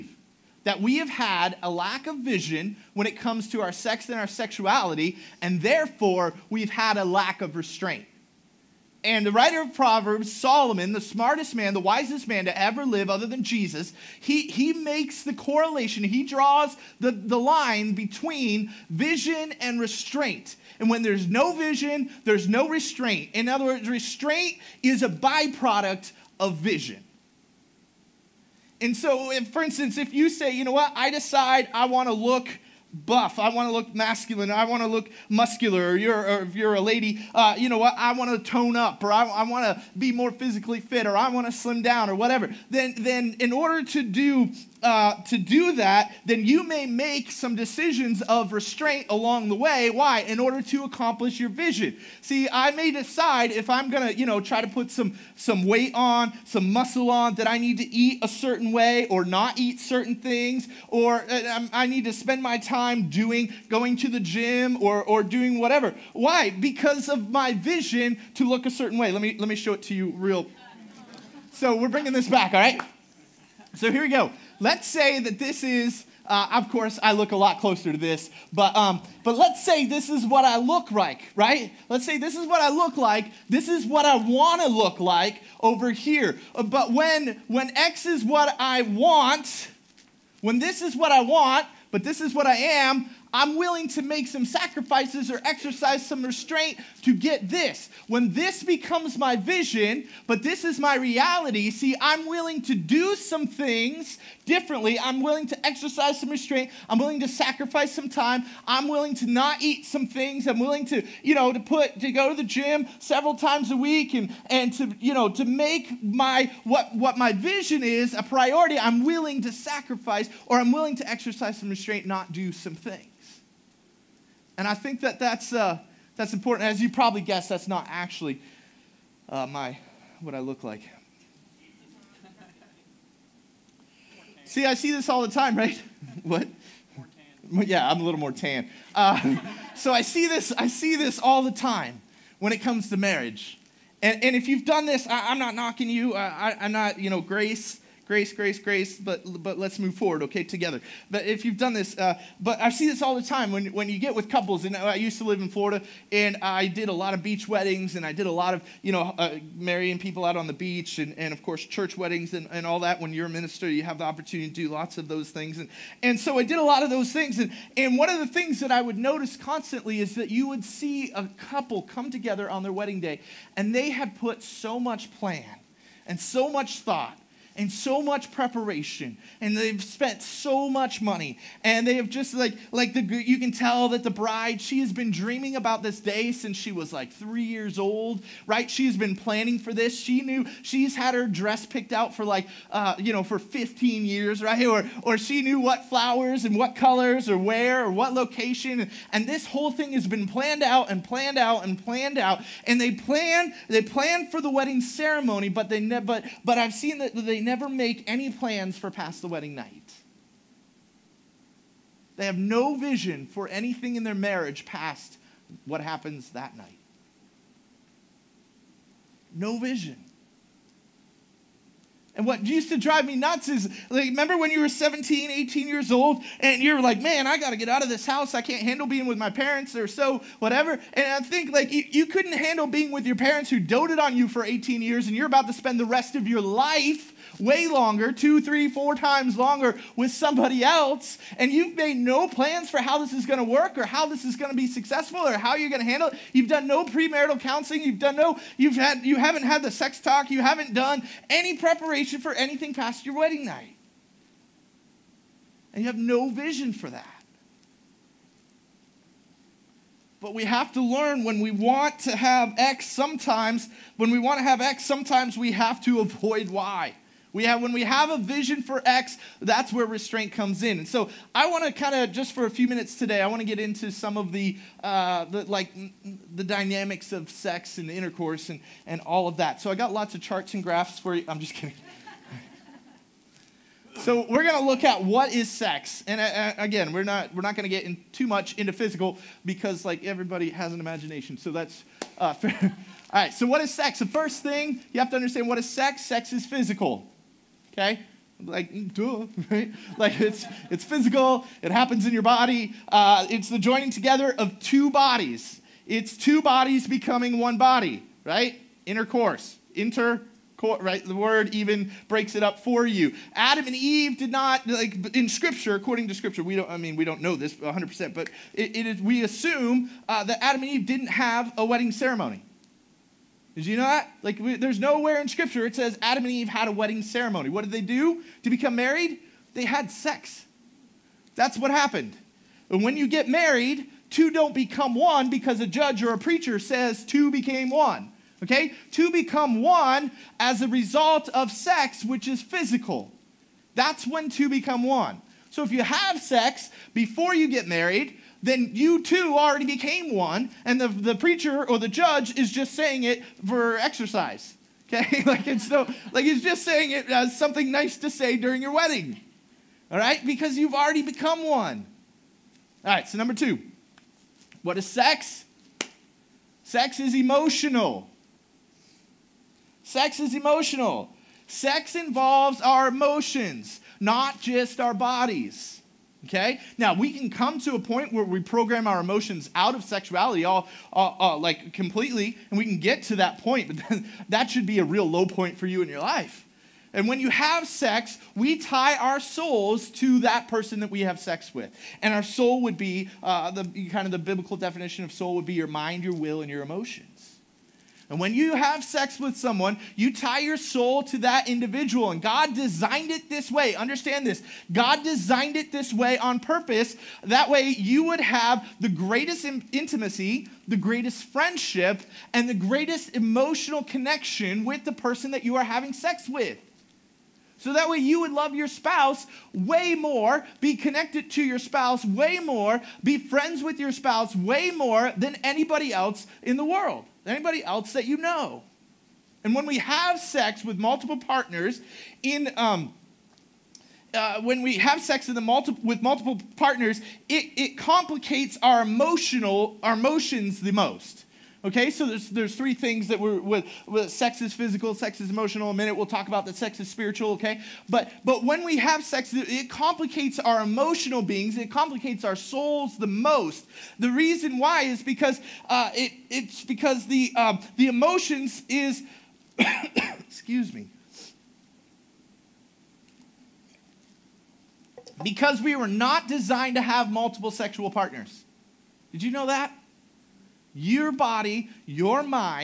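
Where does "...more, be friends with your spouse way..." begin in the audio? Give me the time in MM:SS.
07:02.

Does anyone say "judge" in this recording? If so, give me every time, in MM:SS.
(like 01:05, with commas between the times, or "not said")
05:35, 05:51.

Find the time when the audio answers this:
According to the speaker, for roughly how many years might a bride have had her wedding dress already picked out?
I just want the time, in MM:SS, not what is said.
03:13.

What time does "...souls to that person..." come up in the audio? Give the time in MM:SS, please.
06:29.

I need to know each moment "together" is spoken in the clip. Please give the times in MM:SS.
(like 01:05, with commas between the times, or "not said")
02:30, 02:52, 05:03.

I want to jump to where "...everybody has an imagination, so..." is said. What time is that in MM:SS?
04:50.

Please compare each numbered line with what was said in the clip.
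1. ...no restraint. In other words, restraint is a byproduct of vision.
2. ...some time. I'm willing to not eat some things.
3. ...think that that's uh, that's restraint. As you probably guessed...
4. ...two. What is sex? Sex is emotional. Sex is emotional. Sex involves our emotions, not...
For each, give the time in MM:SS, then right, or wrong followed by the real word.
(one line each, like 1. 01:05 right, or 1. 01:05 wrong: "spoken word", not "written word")
1. 00:22 right
2. 01:47 right
3. 02:04 wrong: "important", not "restraint"
4. 06:03 right.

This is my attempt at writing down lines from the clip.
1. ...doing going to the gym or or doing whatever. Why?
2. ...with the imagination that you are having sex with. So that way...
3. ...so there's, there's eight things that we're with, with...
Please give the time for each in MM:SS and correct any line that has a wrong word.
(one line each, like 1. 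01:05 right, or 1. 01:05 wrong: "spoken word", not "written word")
1. 01:03 right
2. 06:54 wrong: "person", not "imagination"
3. 07:21 wrong: "three", not "eight".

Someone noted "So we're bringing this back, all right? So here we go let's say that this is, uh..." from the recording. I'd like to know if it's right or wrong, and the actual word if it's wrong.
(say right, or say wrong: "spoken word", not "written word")
right.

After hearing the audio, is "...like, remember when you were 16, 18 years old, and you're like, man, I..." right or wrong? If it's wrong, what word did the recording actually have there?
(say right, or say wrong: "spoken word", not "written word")
wrong: "17", not "16".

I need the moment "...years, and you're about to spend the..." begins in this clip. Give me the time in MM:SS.
03:54.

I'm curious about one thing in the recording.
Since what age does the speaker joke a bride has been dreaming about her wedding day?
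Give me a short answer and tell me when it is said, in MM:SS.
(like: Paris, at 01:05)
3 years old, at 03:07.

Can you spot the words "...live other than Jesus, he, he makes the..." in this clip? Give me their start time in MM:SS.
00:12.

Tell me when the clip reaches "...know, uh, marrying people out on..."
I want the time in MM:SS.
02:38.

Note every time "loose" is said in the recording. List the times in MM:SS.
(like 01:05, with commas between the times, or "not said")
not said.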